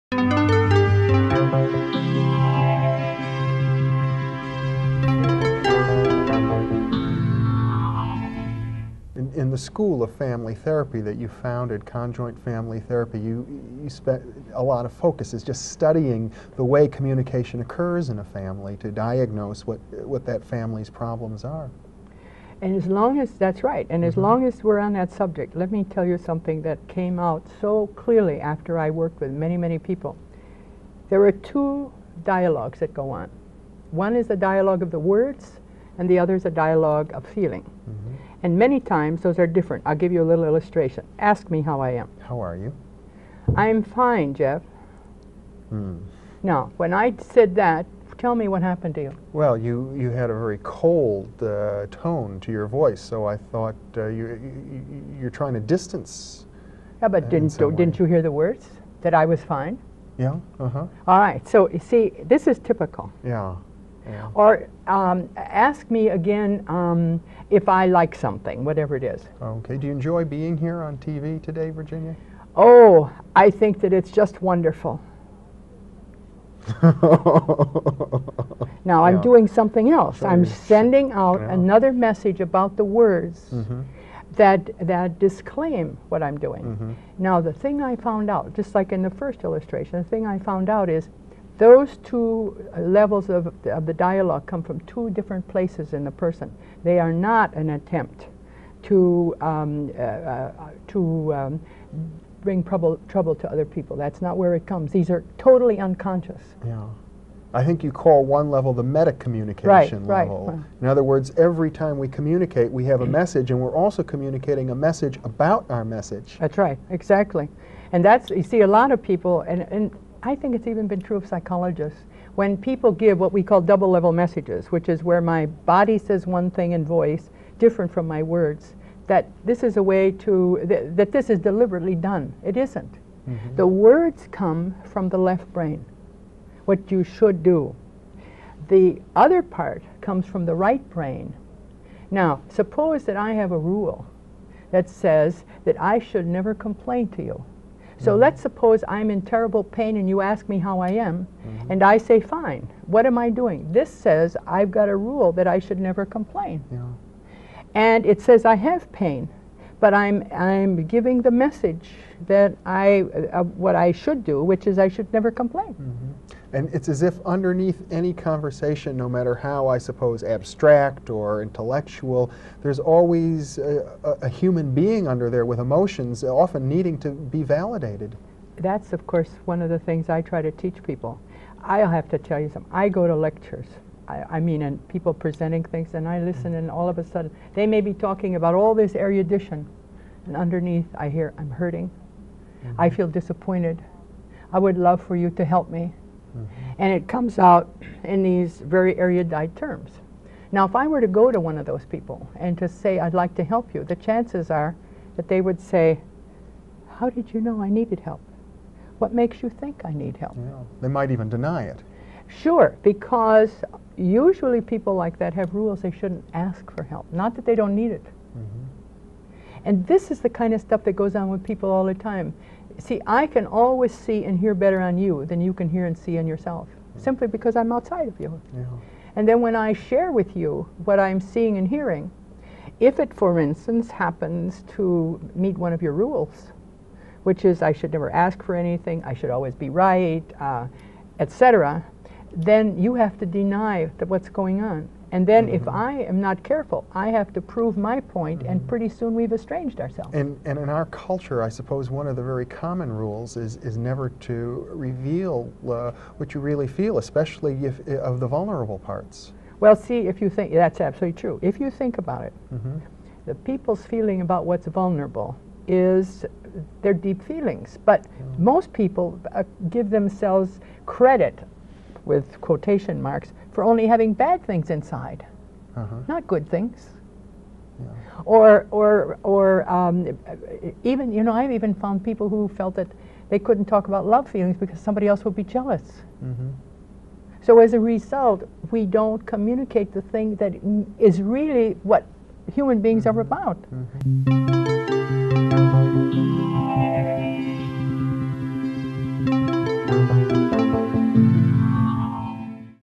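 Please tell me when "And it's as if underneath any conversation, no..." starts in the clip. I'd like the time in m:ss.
2:46.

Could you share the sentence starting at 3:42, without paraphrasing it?
See, I can always see and hear better on you than you can hear and see on yourself, mm -hmm.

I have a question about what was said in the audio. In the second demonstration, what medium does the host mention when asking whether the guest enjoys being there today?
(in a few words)
TV.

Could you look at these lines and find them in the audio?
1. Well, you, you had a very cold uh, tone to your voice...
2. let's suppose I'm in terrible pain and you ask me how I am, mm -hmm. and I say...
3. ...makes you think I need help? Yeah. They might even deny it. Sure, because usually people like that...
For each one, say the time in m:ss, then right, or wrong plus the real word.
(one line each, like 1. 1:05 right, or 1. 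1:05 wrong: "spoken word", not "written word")
1. 0:49 right
2. 2:28 right
3. 3:29 right.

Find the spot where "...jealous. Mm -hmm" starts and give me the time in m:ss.
4:45.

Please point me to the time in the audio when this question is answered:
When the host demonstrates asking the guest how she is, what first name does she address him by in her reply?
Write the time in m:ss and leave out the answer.
0:44.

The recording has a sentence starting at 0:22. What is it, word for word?
And as long as that's right, and mm -hmm.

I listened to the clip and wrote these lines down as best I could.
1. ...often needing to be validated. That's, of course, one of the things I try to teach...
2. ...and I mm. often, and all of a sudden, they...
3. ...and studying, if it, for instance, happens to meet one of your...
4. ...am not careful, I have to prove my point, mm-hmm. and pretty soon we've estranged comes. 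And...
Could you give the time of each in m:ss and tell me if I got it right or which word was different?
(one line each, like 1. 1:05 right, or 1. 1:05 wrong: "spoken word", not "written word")
1. 2:56 right
2. 3:05 wrong: "listen", not "often"
3. 3:51 wrong: "hearing", not "studying"
4. 4:06 wrong: "ourselves", not "comes".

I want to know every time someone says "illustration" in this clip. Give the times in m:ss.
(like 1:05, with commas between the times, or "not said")
0:40, 1:29.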